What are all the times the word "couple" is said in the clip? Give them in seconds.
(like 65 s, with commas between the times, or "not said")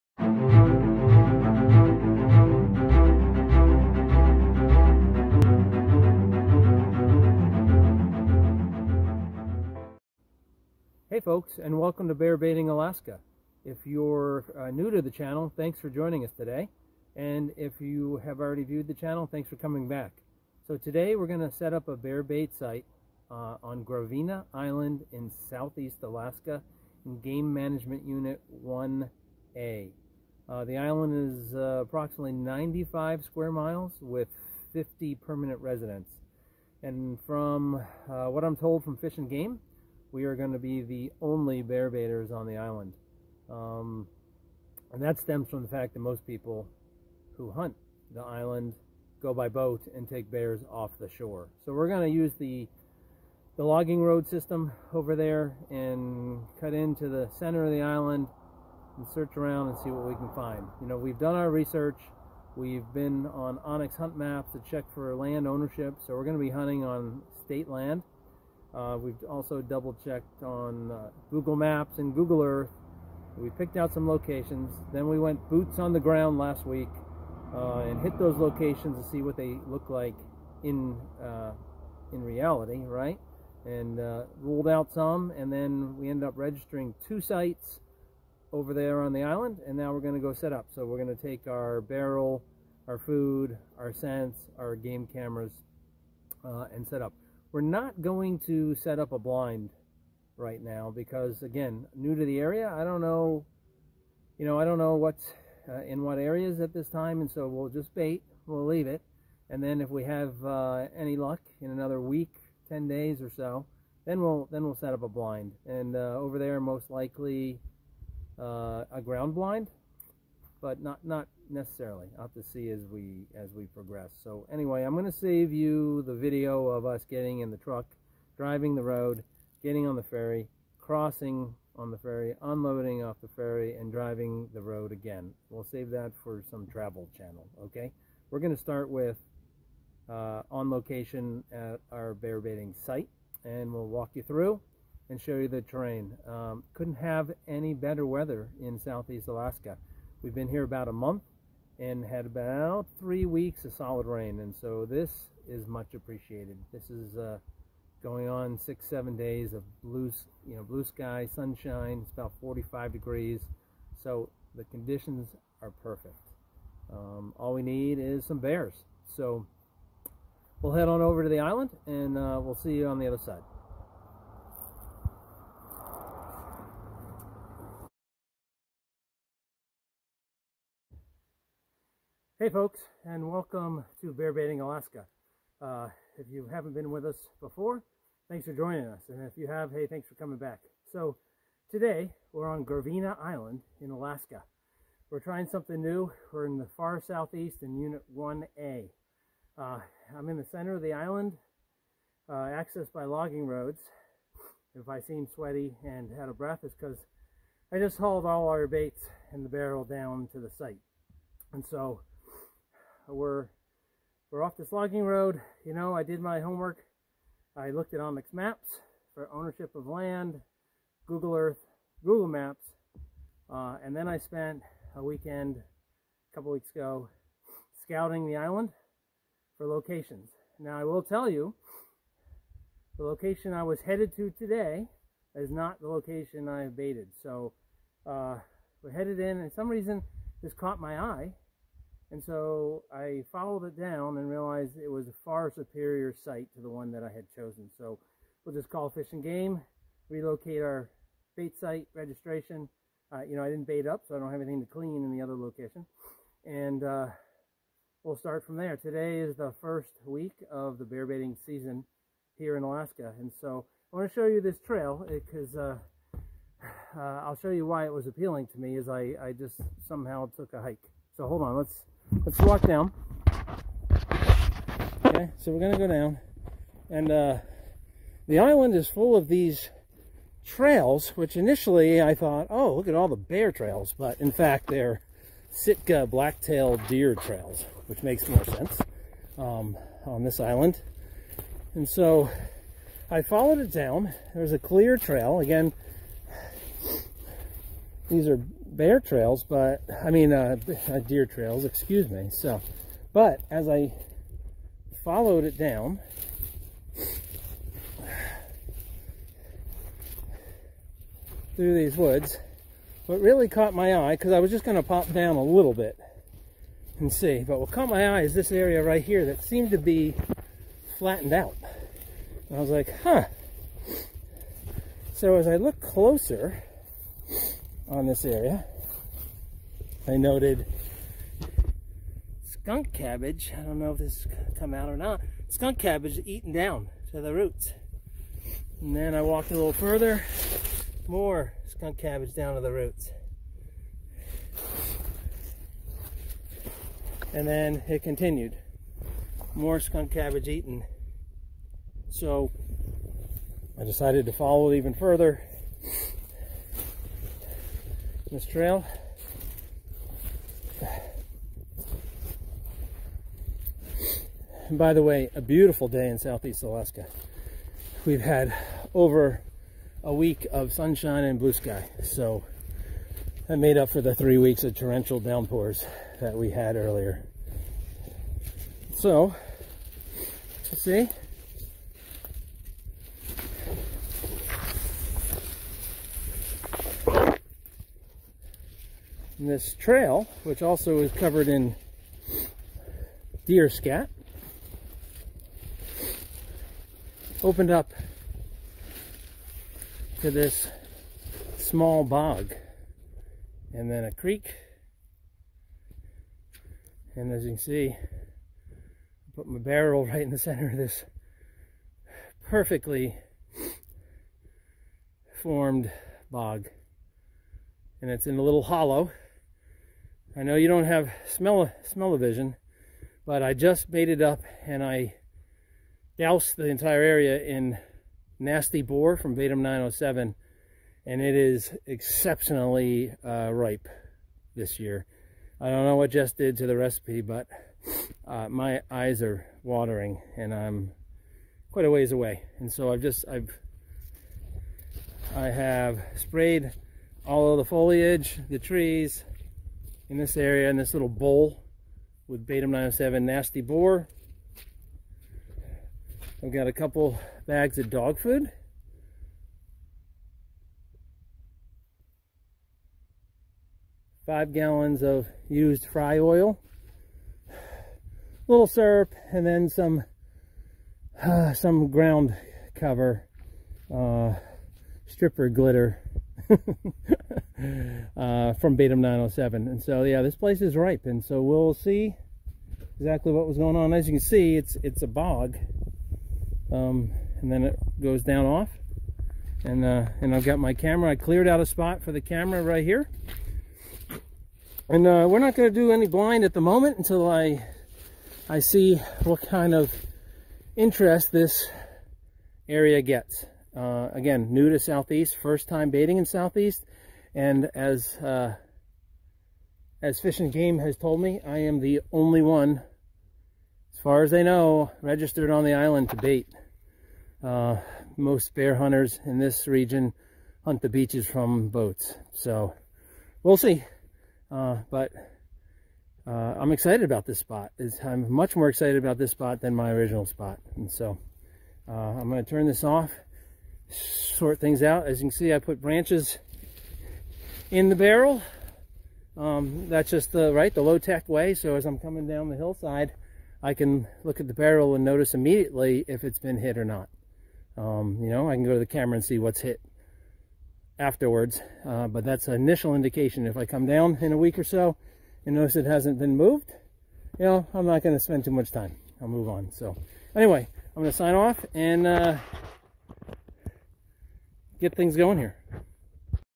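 226 s, 456 s.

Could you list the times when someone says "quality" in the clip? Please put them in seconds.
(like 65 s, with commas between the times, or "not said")
not said.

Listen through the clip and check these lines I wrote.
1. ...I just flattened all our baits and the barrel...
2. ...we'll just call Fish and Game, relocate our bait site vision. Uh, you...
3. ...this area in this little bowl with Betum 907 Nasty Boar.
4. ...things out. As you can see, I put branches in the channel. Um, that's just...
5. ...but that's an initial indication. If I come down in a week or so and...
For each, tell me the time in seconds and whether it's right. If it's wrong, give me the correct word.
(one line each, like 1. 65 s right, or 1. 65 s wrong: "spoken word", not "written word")
1. 207 s wrong: "hauled", not "flattened"
2. 248 s wrong: "registration", not "vision"
3. 450 s right
4. 534 s wrong: "barrel", not "channel"
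5. 552 s right.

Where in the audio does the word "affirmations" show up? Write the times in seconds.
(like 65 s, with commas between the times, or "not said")
not said.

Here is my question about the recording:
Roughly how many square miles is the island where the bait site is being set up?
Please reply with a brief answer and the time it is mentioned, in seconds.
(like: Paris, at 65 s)
95 square miles, at 32 s.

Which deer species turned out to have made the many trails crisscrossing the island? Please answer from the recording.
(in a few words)
Sitka blacktail deer.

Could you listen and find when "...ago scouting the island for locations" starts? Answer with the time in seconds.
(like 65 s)
226 s.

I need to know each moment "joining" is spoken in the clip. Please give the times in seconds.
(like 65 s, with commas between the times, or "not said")
15 s, 188 s.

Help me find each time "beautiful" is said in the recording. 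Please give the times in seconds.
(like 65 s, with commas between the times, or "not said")
365 s.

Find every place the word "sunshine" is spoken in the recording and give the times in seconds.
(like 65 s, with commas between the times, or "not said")
161 s, 370 s.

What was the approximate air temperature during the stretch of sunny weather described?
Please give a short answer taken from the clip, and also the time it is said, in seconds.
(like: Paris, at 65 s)
45 degrees, at 162 s.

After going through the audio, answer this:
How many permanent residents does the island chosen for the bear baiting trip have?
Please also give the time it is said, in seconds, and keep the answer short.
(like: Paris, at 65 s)
50, at 34 s.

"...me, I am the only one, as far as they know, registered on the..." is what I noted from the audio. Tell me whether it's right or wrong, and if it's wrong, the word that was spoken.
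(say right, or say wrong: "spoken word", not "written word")
right.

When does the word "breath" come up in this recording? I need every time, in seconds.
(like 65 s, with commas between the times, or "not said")
206 s.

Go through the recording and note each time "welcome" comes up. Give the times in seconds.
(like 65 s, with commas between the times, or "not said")
11 s, 183 s.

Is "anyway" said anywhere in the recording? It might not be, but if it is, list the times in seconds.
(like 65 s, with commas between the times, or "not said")
124 s, 560 s.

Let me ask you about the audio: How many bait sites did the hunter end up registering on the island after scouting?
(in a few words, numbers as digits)
2.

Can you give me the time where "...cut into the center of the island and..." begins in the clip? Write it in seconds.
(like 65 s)
56 s.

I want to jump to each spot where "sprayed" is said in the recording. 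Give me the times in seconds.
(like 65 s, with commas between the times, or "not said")
446 s.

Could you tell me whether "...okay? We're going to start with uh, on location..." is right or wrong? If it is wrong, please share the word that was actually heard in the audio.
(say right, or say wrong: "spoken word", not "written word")
right.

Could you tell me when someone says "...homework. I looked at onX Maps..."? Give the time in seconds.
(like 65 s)
216 s.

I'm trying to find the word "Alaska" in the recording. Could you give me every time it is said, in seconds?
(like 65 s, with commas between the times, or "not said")
12 s, 26 s, 149 s, 184 s, 193 s, 262 s, 366 s.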